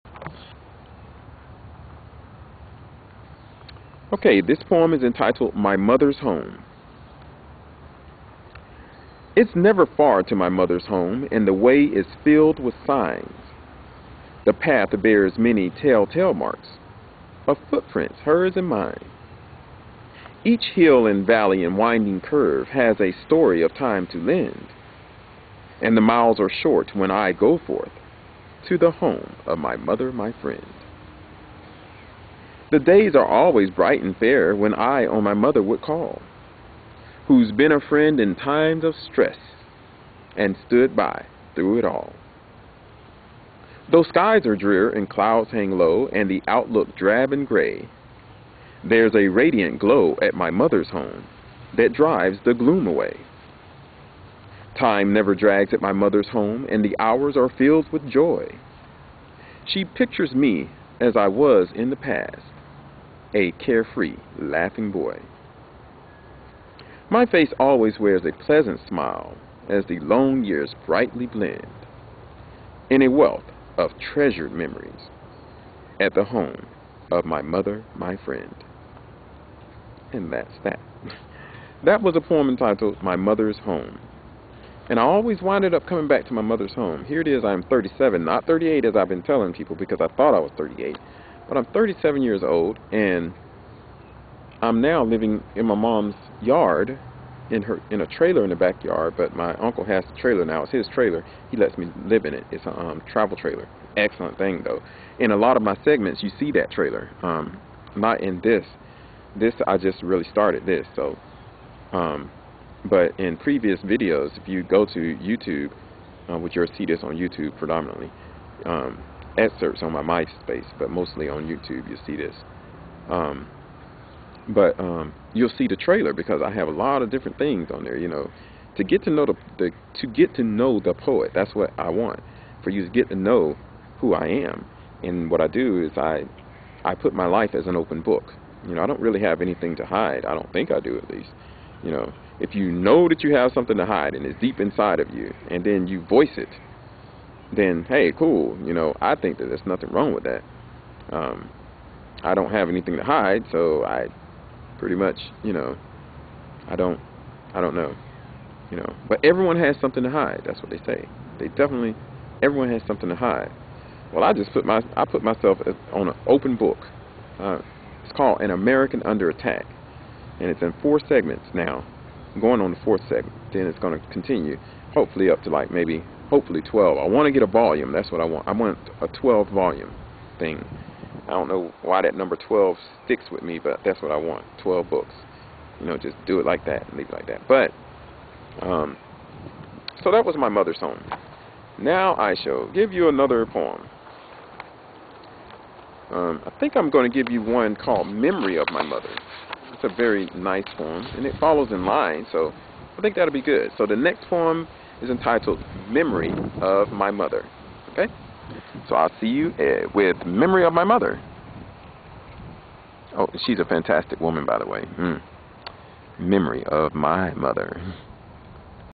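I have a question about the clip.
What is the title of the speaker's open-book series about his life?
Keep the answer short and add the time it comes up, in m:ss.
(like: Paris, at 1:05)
An American Under Attack, at 2:48.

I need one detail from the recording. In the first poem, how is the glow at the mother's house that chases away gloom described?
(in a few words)
radiant.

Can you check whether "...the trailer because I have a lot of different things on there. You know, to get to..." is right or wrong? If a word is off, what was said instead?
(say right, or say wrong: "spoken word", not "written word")
right.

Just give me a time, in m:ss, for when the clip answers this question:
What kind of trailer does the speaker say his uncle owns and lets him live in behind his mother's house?
1:43.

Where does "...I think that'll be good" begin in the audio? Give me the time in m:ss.
3:22.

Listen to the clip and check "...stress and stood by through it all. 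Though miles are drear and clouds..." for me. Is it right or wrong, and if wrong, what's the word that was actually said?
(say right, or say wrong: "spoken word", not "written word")
wrong: "skies", not "miles".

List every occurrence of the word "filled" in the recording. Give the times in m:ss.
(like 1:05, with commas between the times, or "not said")
0:12, 0:57.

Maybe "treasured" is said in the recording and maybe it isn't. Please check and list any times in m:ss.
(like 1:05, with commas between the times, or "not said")
1:13.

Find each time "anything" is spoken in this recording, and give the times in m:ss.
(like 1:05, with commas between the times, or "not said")
2:19, 2:32.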